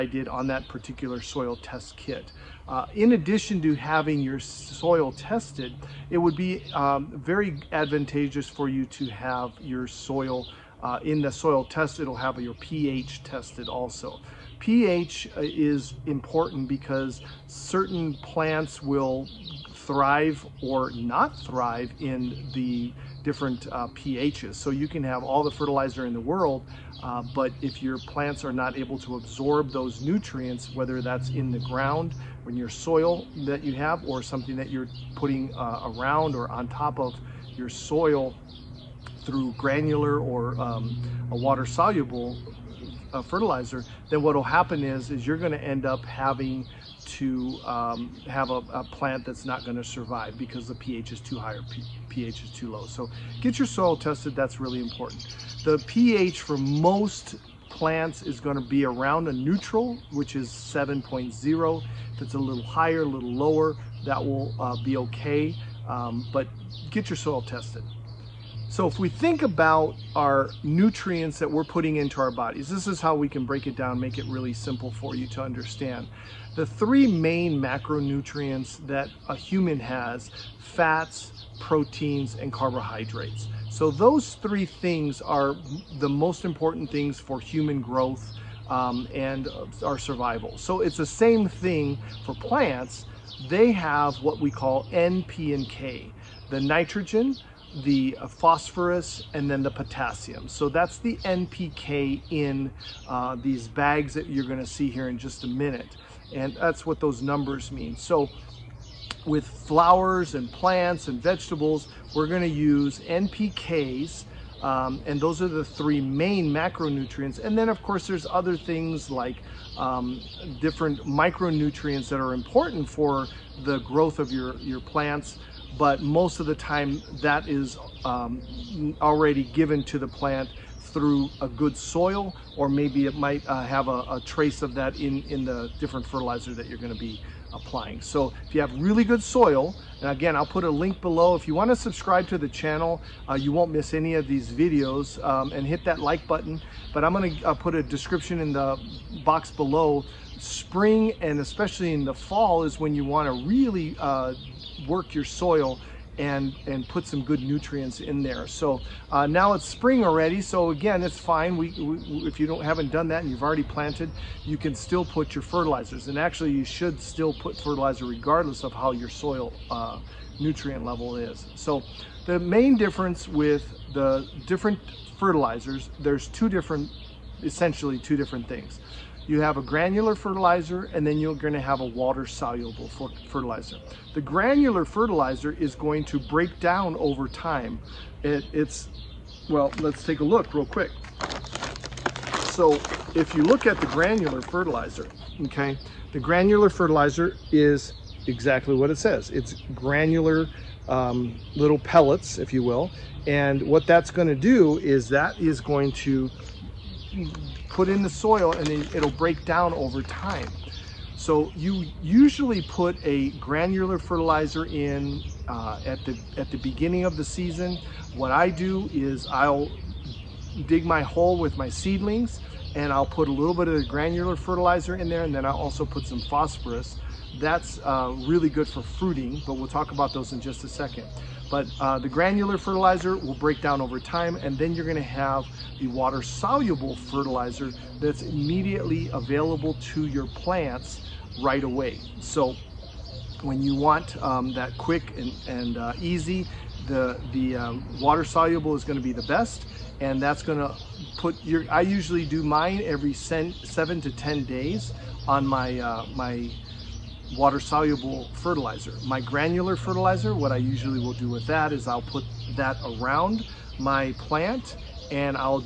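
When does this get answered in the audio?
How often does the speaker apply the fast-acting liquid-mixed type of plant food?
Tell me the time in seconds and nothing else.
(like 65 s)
253 s.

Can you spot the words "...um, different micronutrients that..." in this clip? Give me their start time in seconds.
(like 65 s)
119 s.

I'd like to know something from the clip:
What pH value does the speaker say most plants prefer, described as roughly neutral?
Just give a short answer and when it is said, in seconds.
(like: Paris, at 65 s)
7.0, at 60 s.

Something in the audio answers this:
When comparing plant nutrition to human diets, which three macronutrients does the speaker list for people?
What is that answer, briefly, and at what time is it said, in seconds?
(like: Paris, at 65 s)
fats, proteins, and carbohydrates, at 80 s.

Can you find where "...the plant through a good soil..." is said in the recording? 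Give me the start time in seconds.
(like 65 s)
129 s.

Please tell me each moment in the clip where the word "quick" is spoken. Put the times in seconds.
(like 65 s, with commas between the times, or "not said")
190 s, 244 s.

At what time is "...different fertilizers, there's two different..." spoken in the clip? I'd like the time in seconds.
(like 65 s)
174 s.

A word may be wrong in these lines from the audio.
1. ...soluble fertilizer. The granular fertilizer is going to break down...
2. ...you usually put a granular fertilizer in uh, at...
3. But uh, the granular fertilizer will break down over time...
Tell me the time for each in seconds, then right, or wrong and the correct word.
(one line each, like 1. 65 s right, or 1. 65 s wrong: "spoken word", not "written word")
1. 182 s right
2. 211 s right
3. 231 s right.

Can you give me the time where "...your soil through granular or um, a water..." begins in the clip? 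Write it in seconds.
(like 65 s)
37 s.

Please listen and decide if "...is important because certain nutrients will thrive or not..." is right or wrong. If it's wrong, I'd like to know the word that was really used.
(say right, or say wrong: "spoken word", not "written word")
wrong: "plants", not "nutrients".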